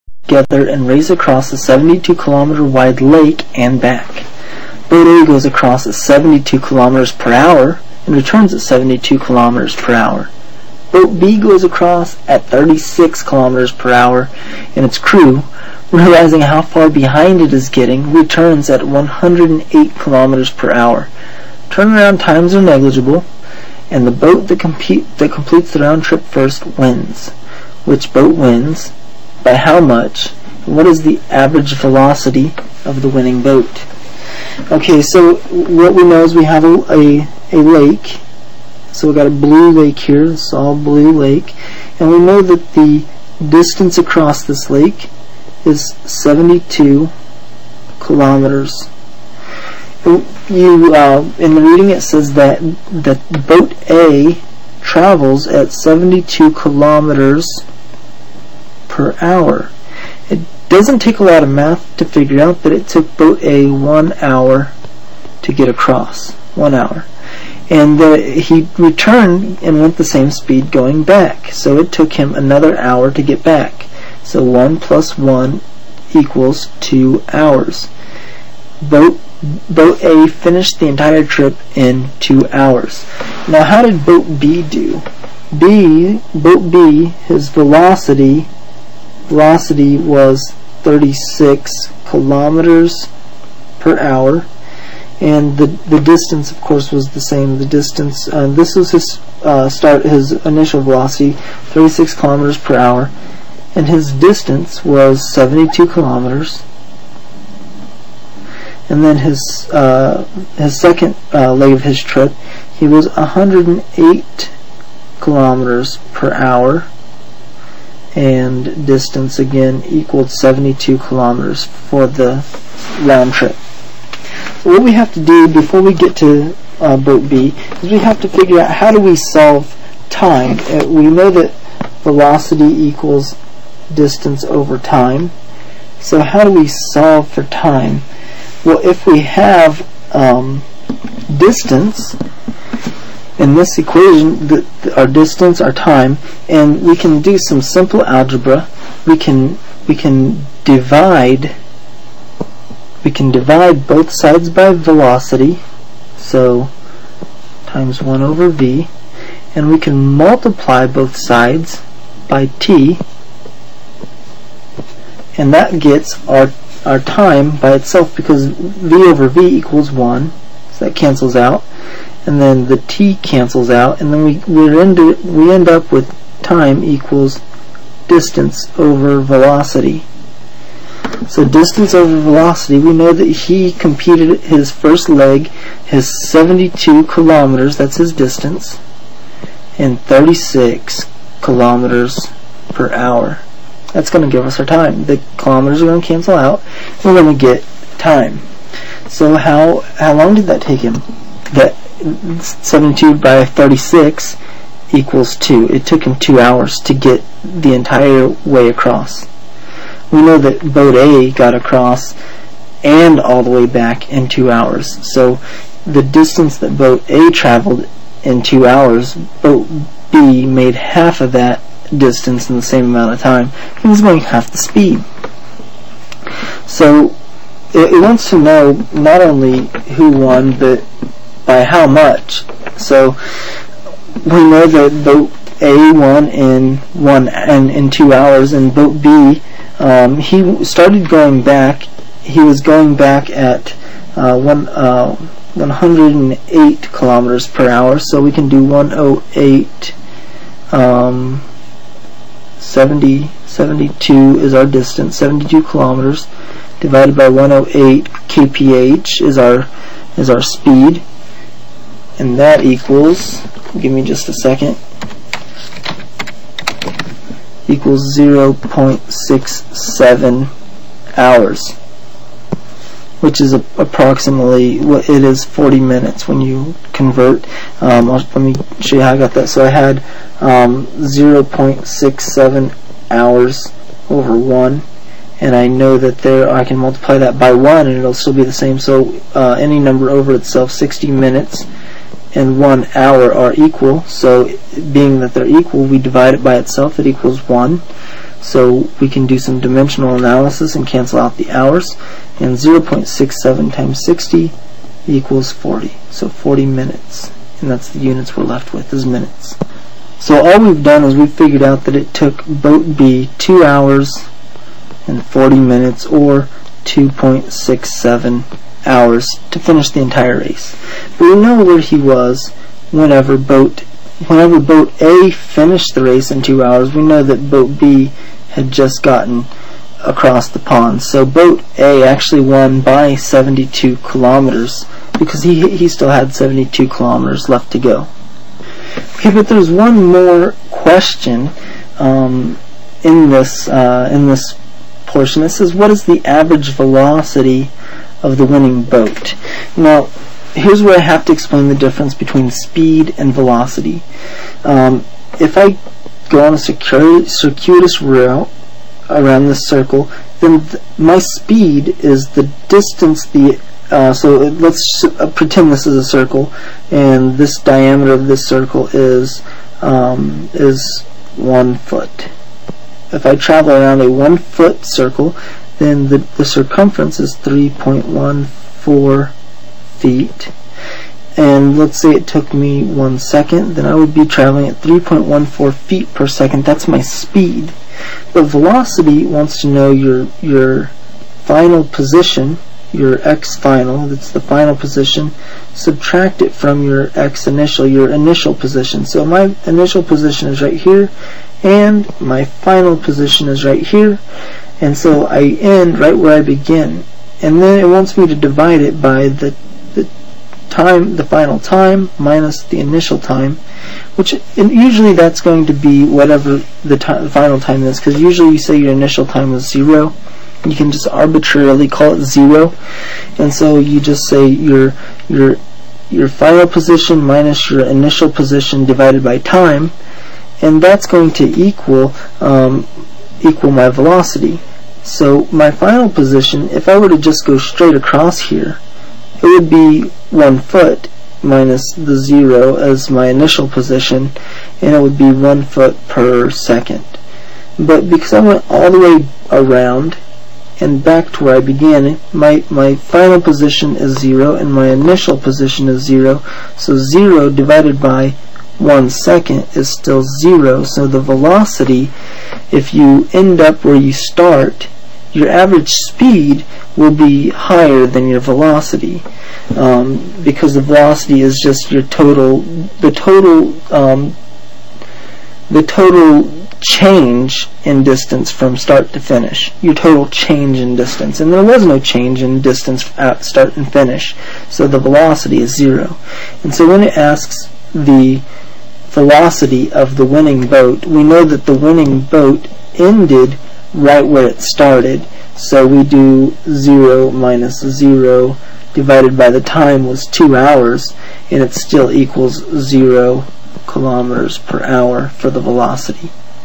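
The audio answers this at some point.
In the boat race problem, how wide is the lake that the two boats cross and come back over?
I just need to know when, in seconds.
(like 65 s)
1 s.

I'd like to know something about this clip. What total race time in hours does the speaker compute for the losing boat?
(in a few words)
2.67 hours.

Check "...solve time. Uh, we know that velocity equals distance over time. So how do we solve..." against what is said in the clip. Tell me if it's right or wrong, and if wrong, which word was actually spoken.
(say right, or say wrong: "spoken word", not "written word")
right.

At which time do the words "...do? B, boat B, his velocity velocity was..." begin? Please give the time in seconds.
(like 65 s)
84 s.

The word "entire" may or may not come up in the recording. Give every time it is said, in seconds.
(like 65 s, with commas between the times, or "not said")
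80 s, 207 s, 320 s.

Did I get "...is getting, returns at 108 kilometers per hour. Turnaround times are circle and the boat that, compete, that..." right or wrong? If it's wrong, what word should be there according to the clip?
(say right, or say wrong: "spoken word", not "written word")
wrong: "negligible", not "circle".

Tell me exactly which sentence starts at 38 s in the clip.
So we've got a blue lake here, it's all blue lake.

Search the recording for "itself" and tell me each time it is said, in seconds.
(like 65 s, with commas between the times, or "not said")
167 s, 290 s, 296 s.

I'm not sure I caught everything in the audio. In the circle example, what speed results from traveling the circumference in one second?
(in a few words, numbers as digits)
3.14 feet per second.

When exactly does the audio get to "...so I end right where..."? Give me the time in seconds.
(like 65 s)
404 s.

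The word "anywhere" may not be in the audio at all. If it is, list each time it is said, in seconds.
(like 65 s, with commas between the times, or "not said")
not said.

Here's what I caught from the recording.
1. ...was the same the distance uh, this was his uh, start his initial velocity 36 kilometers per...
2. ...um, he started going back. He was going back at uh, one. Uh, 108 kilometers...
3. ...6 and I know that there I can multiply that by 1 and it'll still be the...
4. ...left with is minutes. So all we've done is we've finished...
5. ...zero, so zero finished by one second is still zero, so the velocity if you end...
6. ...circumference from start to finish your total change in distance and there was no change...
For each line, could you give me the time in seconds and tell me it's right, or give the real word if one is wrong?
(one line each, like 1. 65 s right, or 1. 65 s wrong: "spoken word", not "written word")
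1. 96 s right
2. 239 s right
3. 284 s wrong: "1", not "6"
4. 308 s wrong: "figured", not "finished"
5. 456 s wrong: "divided", not "finished"
6. 478 s wrong: "distance", not "circumference".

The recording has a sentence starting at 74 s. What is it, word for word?
So 1 plus 1 equals 2 hours.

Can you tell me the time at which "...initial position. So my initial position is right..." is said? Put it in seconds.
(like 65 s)
398 s.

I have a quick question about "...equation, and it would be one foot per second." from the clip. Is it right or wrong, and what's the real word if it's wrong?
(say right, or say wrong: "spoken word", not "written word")
wrong: "position", not "equation".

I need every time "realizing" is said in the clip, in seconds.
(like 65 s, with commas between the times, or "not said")
15 s.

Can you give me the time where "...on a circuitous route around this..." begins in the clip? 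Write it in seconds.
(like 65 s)
356 s.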